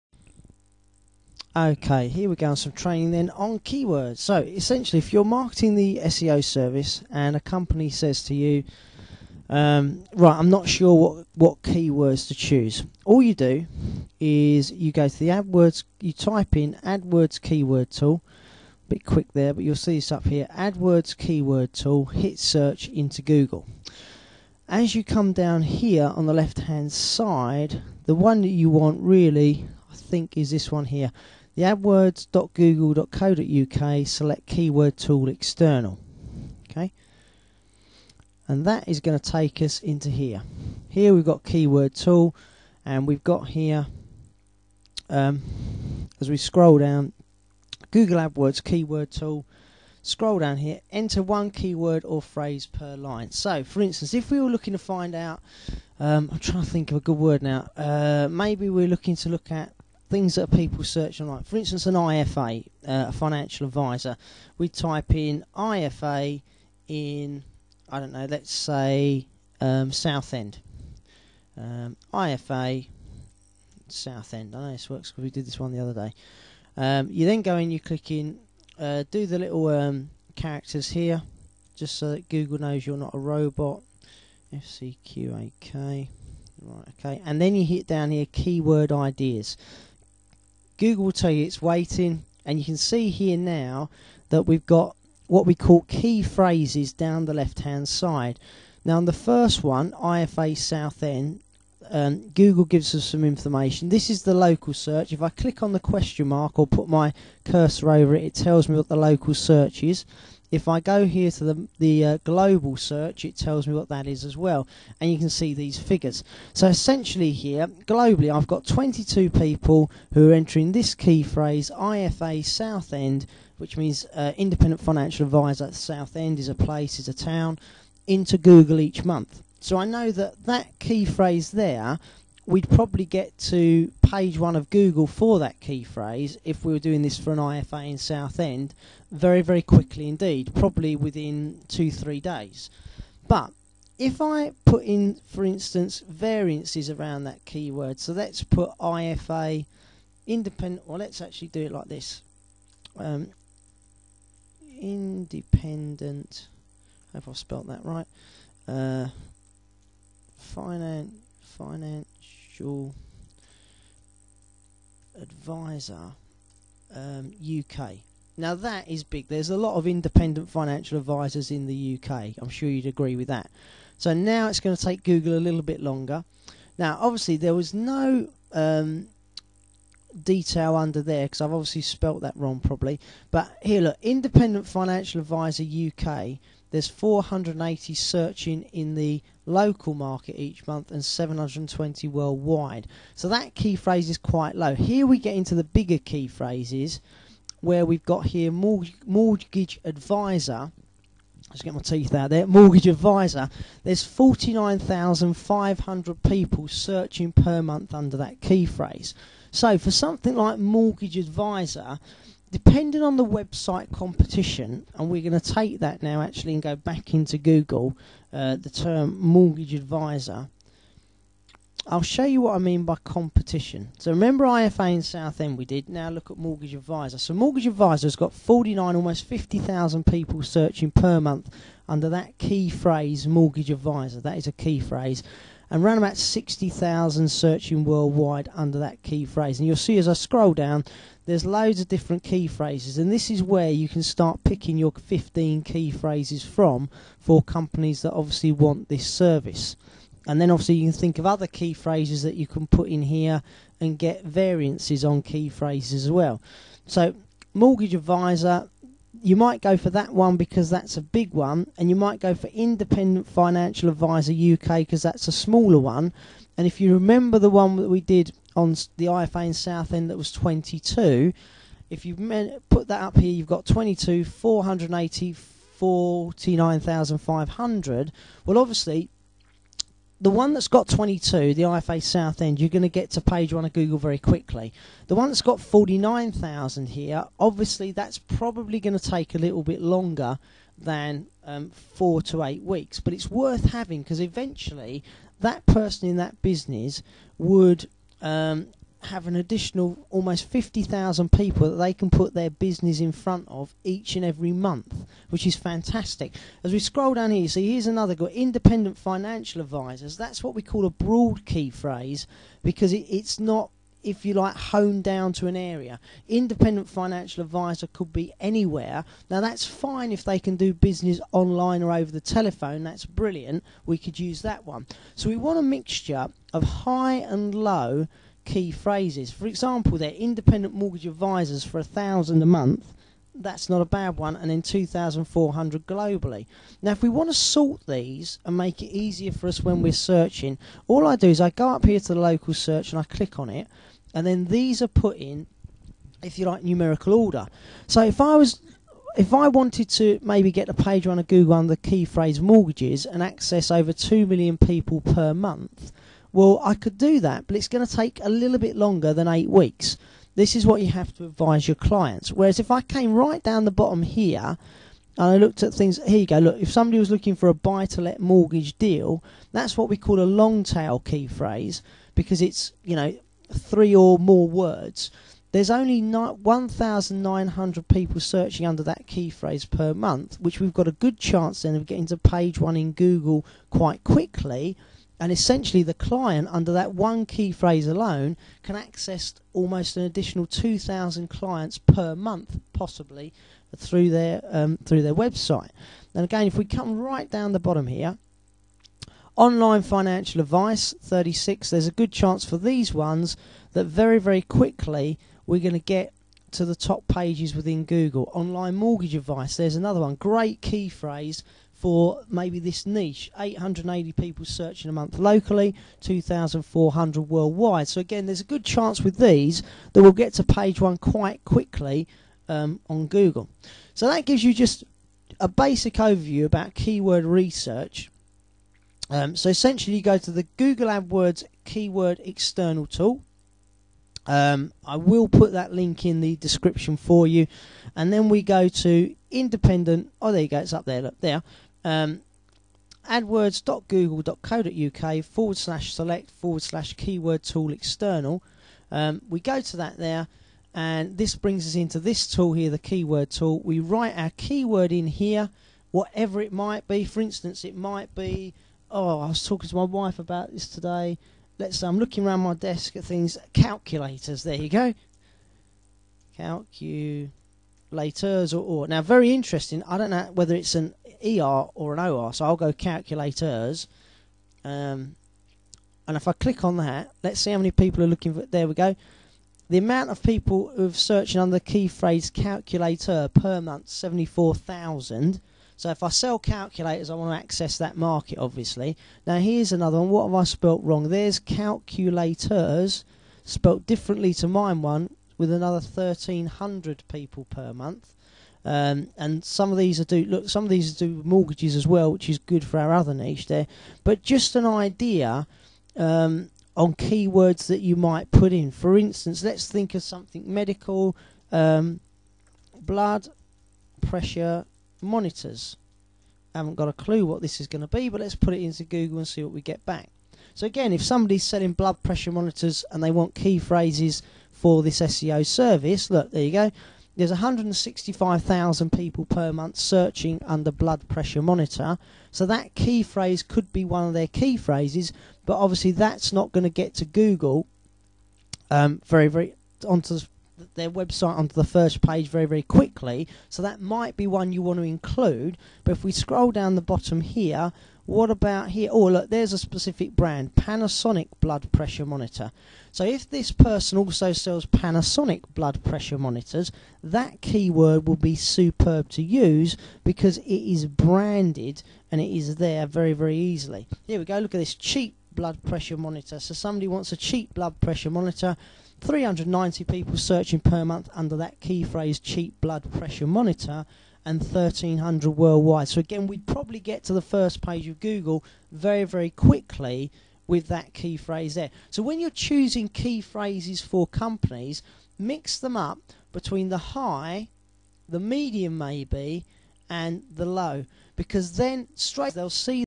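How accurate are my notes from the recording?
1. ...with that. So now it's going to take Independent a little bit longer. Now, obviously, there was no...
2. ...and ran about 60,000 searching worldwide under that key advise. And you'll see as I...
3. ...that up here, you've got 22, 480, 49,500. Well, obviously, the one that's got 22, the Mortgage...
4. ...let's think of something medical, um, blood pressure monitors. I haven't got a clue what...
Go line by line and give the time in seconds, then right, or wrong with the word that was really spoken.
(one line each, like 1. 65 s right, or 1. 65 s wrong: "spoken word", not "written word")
1. 173 s wrong: "Google", not "Independent"
2. 235 s wrong: "phrase", not "advise"
3. 272 s wrong: "IFA", not "Mortgage"
4. 509 s right.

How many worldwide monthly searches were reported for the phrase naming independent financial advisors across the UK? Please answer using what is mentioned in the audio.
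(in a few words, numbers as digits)
720.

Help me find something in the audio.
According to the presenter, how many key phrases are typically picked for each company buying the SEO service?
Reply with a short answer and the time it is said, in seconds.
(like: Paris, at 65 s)
15, at 244 s.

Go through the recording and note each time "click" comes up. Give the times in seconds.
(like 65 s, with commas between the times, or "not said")
77 s, 105 s, 343 s, 476 s.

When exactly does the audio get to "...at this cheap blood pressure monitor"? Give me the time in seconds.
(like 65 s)
564 s.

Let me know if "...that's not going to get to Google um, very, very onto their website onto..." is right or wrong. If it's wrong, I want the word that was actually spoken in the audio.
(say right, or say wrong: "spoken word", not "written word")
right.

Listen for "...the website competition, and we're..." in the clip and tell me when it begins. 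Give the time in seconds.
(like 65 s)
213 s.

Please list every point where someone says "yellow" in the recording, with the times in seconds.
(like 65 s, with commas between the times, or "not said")
not said.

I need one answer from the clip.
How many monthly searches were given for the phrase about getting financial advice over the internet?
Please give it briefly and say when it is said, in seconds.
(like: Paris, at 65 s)
36, at 401 s.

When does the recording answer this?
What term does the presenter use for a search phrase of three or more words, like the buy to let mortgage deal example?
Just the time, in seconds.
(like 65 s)
370 s.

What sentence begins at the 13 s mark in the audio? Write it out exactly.
All you do is you go to the AdWords, you type in AdWords keyword tool.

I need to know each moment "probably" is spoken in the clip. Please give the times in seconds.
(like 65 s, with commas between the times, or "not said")
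132 s, 140 s, 182 s, 288 s, 576 s.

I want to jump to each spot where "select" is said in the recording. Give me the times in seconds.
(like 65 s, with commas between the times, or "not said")
34 s, 445 s.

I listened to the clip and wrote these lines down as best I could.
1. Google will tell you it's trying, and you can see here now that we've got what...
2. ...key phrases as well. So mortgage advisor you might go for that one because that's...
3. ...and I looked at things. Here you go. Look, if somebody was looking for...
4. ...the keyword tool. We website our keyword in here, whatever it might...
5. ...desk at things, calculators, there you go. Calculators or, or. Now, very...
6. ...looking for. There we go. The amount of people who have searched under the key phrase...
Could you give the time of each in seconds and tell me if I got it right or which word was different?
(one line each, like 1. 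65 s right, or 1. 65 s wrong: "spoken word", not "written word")
1. 90 s wrong: "waiting", not "trying"
2. 255 s right
3. 365 s right
4. 452 s wrong: "write", not "website"
5. 462 s right
6. 478 s right.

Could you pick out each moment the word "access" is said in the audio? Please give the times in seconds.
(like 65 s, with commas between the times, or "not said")
353 s, 388 s, 487 s.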